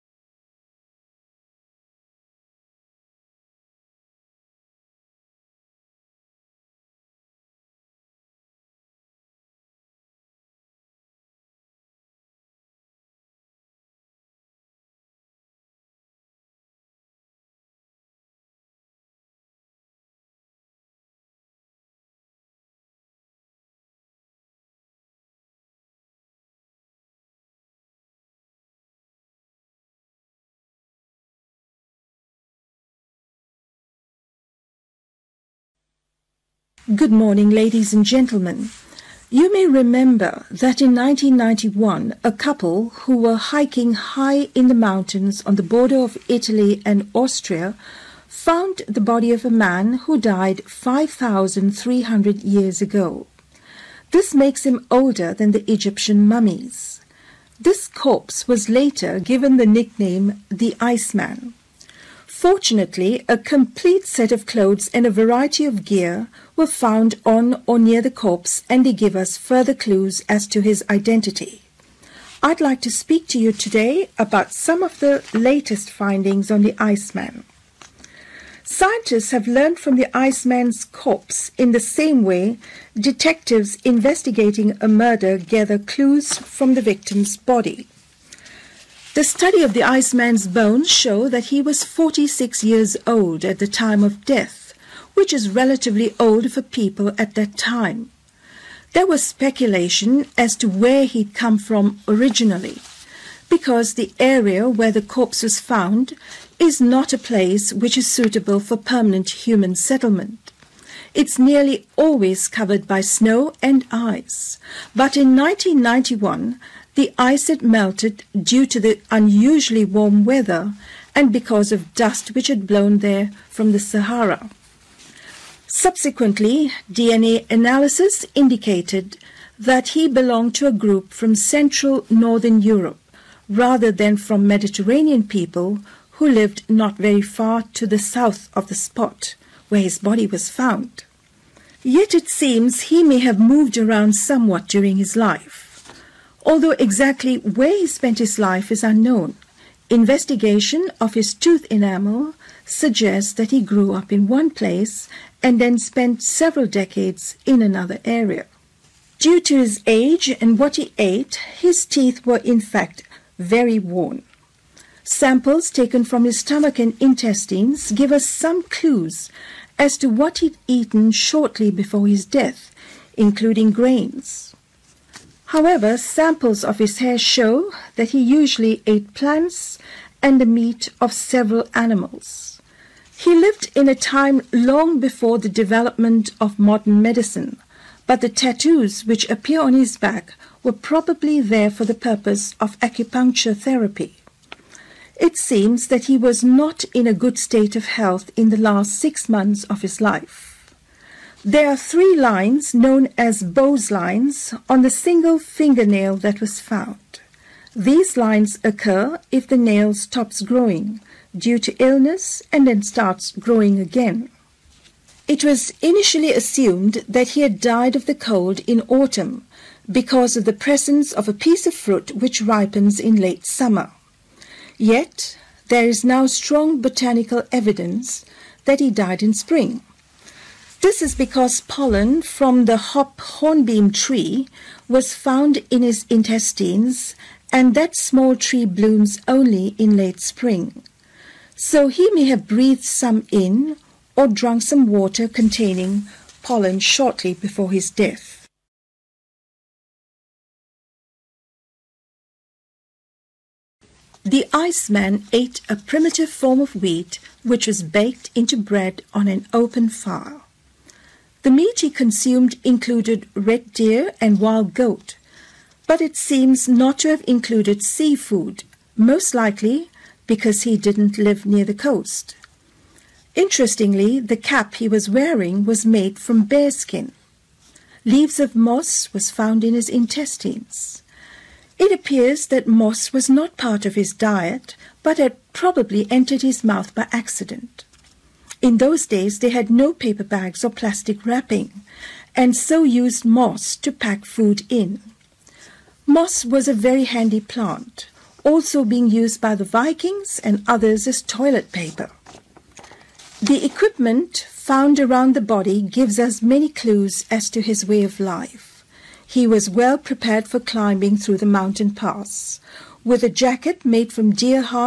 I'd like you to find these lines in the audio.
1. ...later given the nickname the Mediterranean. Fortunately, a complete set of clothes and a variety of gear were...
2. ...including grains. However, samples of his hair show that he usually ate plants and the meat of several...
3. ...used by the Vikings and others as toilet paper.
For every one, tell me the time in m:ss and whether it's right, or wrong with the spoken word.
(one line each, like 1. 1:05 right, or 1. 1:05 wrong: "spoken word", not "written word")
1. 0:58 wrong: "Iceman", not "Mediterranean"
2. 2:53 right
3. 4:59 right.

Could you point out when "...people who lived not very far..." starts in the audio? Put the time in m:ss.
2:15.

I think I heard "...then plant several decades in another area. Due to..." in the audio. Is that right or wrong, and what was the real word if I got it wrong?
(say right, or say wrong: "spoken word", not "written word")
wrong: "spent", not "plant".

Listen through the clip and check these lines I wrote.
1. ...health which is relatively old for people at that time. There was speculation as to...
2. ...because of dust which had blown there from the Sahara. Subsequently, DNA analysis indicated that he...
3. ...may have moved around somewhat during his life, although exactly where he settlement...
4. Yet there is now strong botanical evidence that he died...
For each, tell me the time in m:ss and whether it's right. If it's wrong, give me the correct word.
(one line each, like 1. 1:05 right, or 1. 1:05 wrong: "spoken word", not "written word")
1. 1:34 wrong: "death", not "health"
2. 2:01 right
3. 2:23 wrong: "spent", not "settlement"
4. 3:44 right.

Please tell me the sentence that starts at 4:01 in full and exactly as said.
So he may have breathed some in or drunk some water containing pollen shortly before his death.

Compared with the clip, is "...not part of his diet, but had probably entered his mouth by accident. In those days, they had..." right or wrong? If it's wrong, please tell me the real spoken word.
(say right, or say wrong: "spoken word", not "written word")
right.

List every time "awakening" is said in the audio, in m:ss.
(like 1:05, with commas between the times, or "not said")
not said.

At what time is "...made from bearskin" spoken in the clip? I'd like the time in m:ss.
4:35.